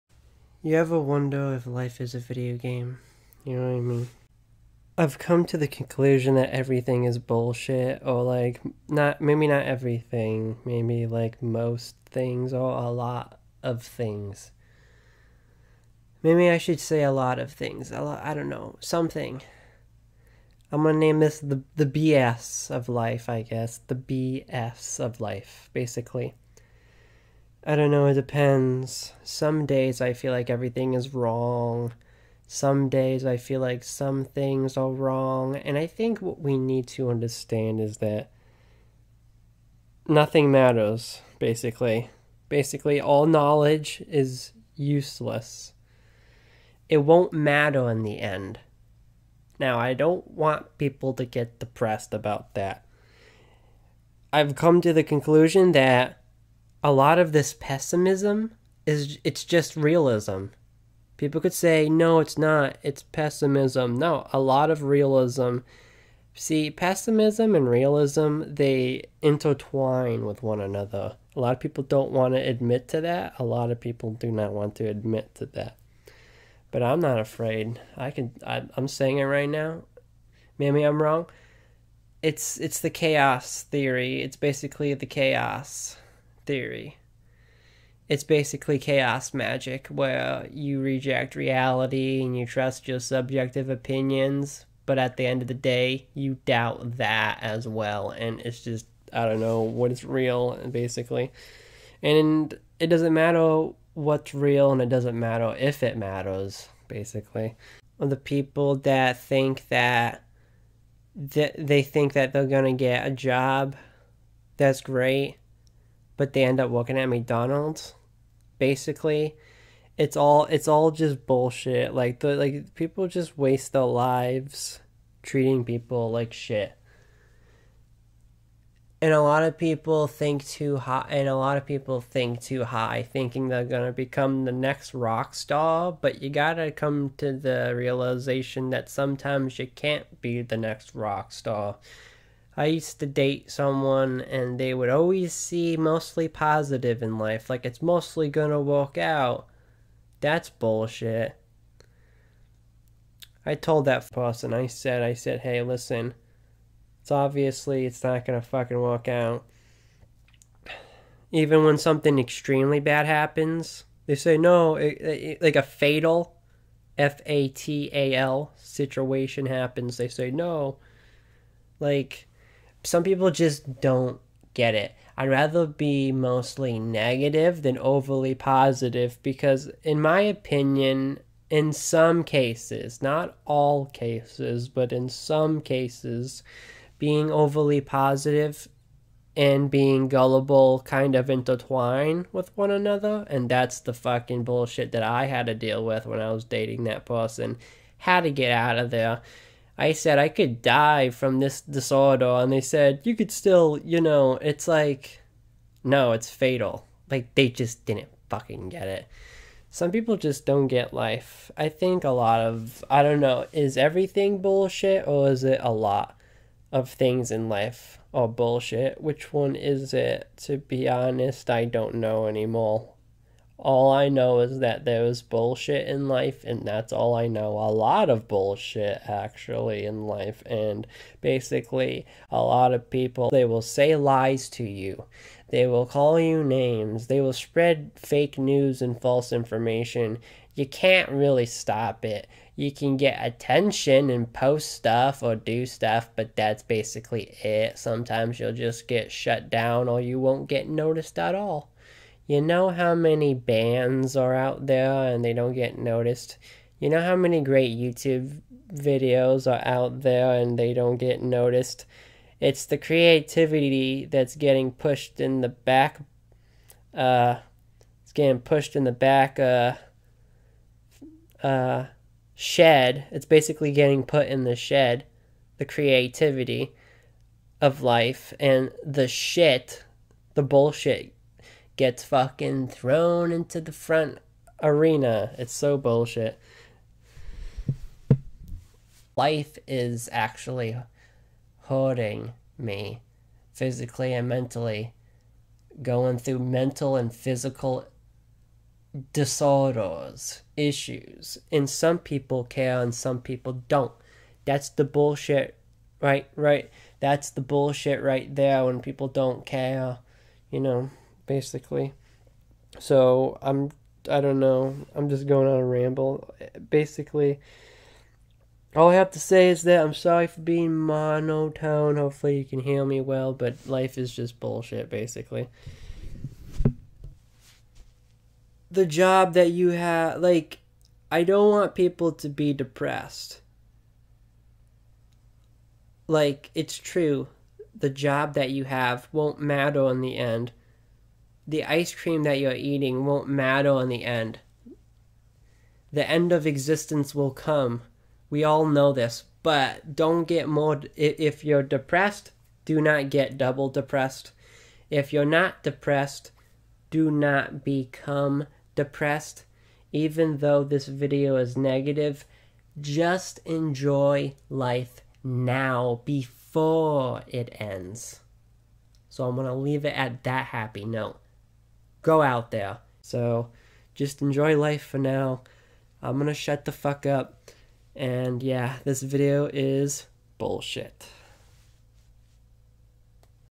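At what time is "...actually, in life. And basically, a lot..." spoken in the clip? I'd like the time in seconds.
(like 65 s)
229 s.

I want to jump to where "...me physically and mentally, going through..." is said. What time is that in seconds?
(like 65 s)
292 s.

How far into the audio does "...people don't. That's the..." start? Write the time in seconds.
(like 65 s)
303 s.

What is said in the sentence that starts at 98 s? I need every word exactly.
And it's just, I don't know what is real, basically.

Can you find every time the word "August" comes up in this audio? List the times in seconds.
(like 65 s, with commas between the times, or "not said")
not said.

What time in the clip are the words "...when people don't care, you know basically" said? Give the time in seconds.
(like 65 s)
308 s.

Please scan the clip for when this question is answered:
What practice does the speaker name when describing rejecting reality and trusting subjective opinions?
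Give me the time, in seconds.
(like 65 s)
88 s.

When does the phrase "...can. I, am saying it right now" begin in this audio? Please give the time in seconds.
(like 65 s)
78 s.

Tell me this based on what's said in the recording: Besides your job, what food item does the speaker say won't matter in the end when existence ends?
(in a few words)
Ice cream.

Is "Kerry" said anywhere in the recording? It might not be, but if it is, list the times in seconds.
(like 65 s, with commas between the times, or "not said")
not said.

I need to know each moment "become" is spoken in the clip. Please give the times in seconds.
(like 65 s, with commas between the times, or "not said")
133 s, 357 s.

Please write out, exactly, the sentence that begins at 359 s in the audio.
Even though this video is negative, just enjoy life now before it ends.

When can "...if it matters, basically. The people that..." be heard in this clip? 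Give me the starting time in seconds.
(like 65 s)
105 s.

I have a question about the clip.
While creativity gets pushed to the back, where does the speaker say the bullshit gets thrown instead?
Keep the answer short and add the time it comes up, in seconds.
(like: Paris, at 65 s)
The front arena, at 283 s.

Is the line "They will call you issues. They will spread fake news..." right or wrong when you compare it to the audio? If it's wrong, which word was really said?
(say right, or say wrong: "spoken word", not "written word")
wrong: "names", not "issues".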